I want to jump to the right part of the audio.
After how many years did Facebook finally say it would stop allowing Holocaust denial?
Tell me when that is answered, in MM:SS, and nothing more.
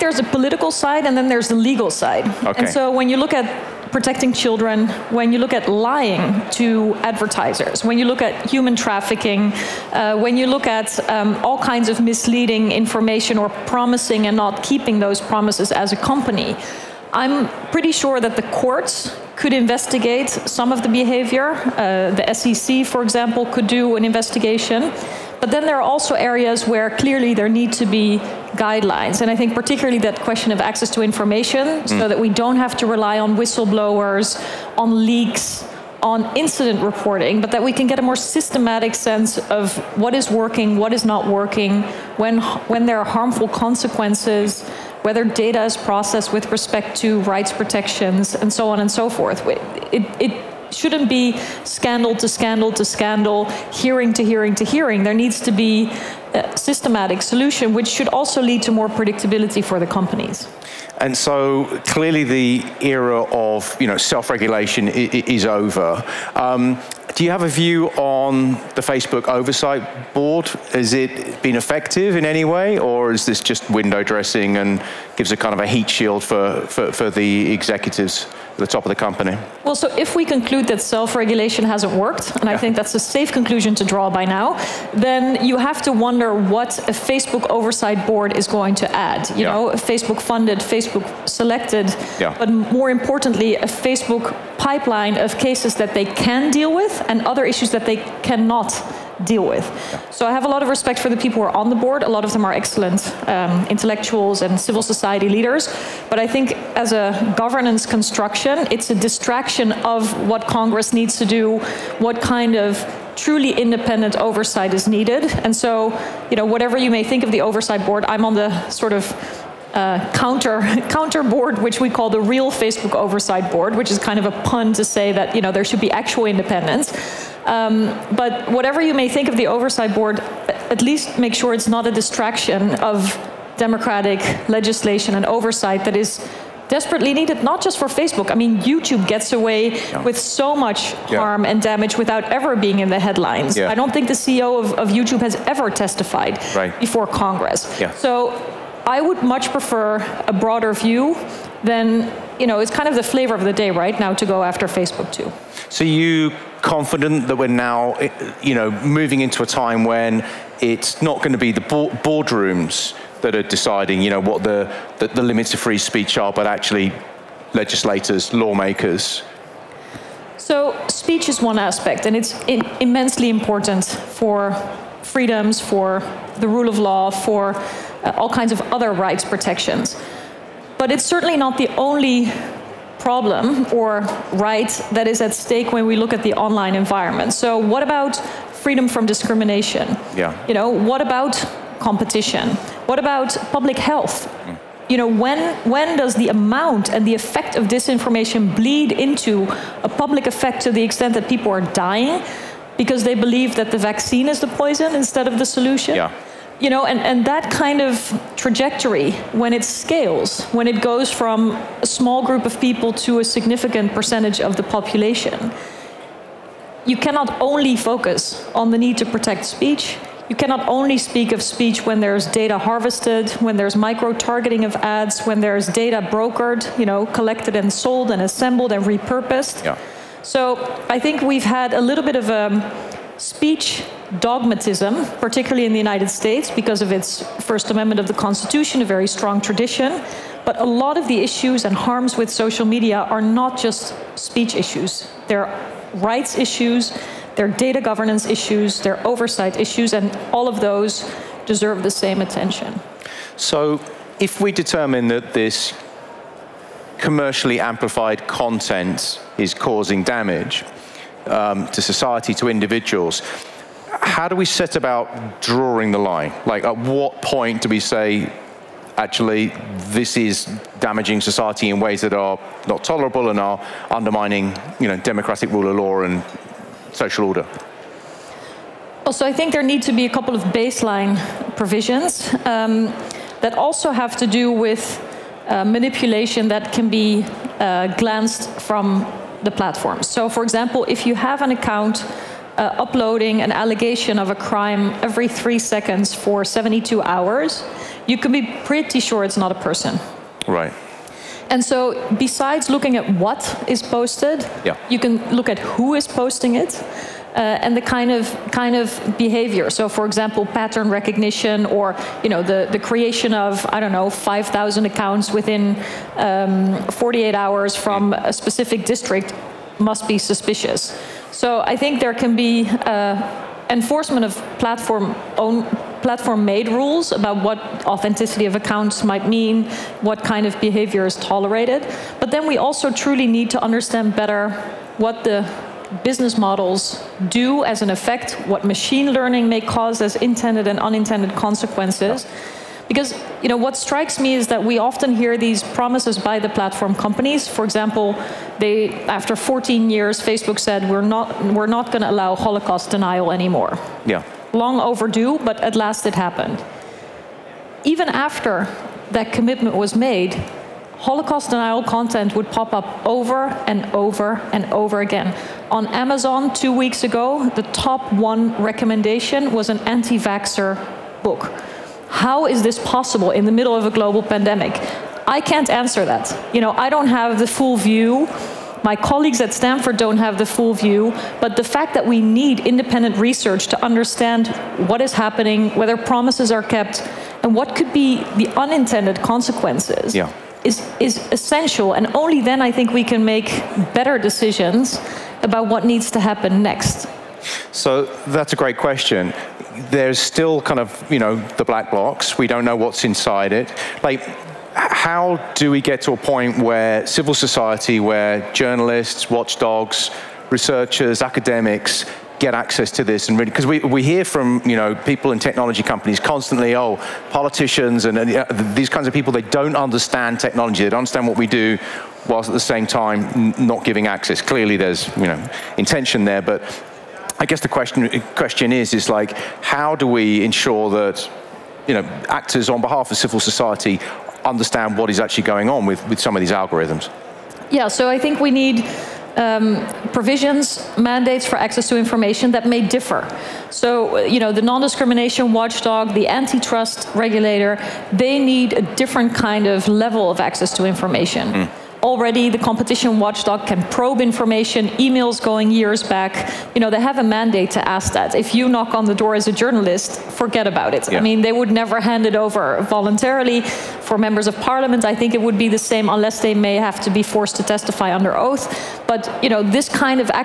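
05:49.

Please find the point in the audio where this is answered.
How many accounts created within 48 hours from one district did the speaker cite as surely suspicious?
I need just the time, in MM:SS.
05:14.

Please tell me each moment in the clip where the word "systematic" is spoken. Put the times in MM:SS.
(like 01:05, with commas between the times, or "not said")
00:38, 00:56.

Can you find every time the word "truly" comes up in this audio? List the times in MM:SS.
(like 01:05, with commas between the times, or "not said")
01:53, 05:32.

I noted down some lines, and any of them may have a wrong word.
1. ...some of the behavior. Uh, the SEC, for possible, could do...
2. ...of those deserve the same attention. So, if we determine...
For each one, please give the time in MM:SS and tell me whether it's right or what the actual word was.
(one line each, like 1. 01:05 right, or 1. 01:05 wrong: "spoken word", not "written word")
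1. 00:20 wrong: "example", not "possible"
2. 04:10 right.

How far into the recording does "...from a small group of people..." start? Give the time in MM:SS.
03:31.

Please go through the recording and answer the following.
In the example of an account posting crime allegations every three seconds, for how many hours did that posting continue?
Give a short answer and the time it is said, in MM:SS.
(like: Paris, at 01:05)
72, at 04:56.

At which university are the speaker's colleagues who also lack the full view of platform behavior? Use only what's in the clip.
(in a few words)
Stanford.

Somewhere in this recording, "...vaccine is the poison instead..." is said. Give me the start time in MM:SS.
03:23.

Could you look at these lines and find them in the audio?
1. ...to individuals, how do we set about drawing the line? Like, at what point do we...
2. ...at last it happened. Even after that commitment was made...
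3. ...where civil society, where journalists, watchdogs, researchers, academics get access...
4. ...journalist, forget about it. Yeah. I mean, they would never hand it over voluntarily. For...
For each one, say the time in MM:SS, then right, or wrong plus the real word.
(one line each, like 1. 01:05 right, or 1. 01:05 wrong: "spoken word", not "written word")
1. 04:22 right
2. 05:55 right
3. 06:46 right
4. 07:39 right.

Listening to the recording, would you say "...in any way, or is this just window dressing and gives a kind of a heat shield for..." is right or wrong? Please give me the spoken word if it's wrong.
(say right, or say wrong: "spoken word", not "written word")
right.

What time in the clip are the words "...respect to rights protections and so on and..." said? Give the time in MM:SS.
00:46.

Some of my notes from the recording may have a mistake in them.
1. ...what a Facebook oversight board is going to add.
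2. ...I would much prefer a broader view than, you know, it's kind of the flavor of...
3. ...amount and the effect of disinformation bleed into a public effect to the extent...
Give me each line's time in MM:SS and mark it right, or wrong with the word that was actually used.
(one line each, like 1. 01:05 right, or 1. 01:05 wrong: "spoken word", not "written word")
1. 01:26 right
2. 02:28 right
3. 03:16 right.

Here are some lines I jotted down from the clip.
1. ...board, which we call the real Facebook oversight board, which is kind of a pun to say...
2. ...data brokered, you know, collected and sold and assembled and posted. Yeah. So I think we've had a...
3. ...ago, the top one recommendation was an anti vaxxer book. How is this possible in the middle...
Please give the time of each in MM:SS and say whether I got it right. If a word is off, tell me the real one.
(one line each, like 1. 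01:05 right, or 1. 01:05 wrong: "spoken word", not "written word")
1. 02:01 right
2. 03:45 wrong: "repurposed", not "posted"
3. 06:07 right.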